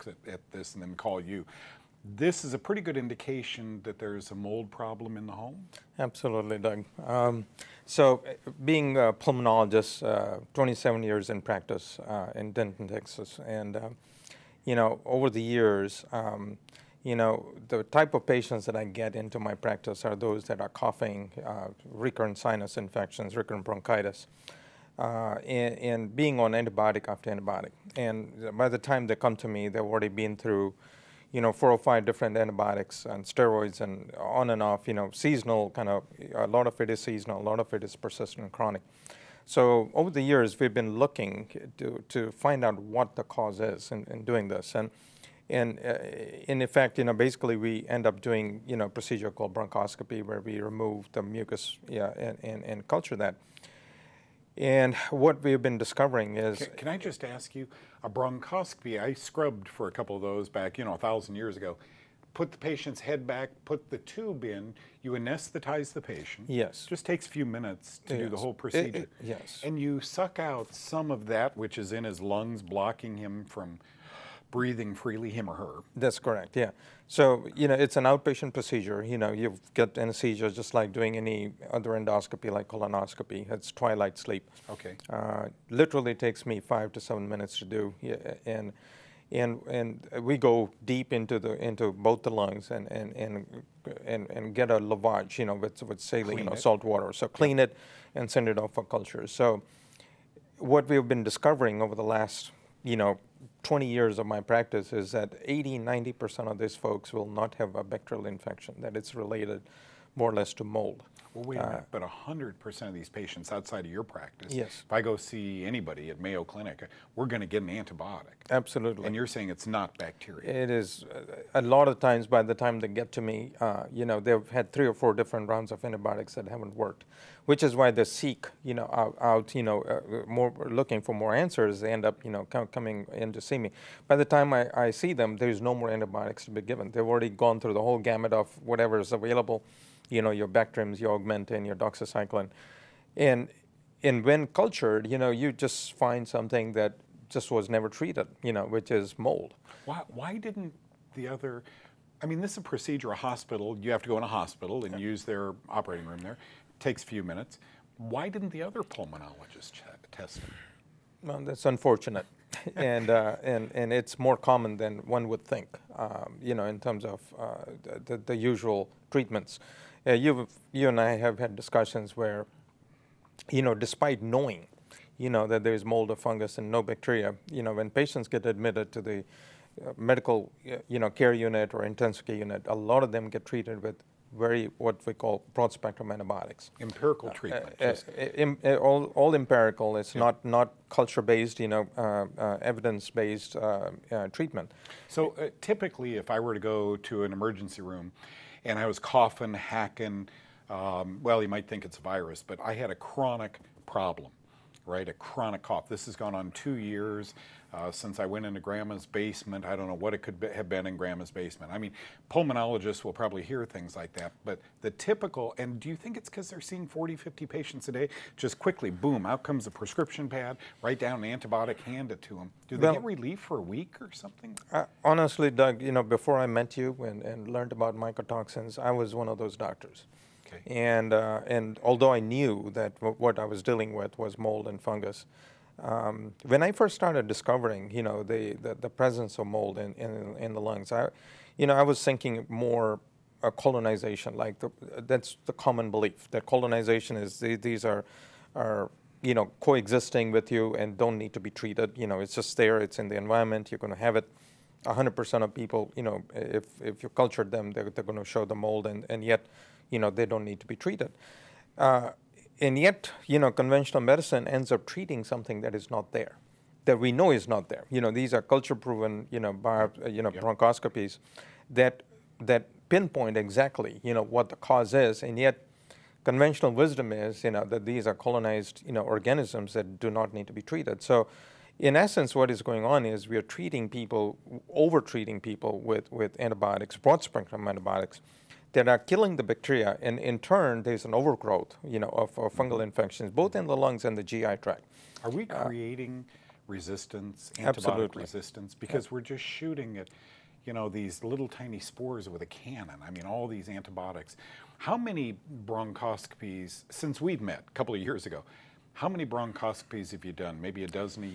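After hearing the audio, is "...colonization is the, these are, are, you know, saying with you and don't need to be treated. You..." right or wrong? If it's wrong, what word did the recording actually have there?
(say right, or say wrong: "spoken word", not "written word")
wrong: "coexisting", not "saying".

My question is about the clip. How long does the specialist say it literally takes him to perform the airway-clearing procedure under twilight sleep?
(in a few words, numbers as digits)
5 to 7 minutes.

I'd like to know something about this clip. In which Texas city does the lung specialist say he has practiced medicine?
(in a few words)
Denton.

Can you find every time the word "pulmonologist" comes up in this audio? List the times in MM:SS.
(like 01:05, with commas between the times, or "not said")
00:09, 02:38, 03:32.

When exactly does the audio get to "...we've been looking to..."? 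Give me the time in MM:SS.
00:40.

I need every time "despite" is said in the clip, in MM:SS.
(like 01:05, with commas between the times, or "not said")
02:53.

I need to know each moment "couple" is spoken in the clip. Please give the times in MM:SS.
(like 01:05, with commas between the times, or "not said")
00:59, 05:07.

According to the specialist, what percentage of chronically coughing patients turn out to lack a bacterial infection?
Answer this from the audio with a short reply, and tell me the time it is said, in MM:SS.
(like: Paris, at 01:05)
80-90%, at 01:45.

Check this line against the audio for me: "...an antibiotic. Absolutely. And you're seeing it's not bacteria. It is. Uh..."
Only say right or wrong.
wrong.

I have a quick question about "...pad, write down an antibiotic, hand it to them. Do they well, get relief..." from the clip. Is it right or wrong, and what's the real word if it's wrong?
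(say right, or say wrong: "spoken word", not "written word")
right.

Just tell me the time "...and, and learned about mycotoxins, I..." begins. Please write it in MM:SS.
03:47.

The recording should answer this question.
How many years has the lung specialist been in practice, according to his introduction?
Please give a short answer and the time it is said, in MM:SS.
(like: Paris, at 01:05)
27, at 00:10.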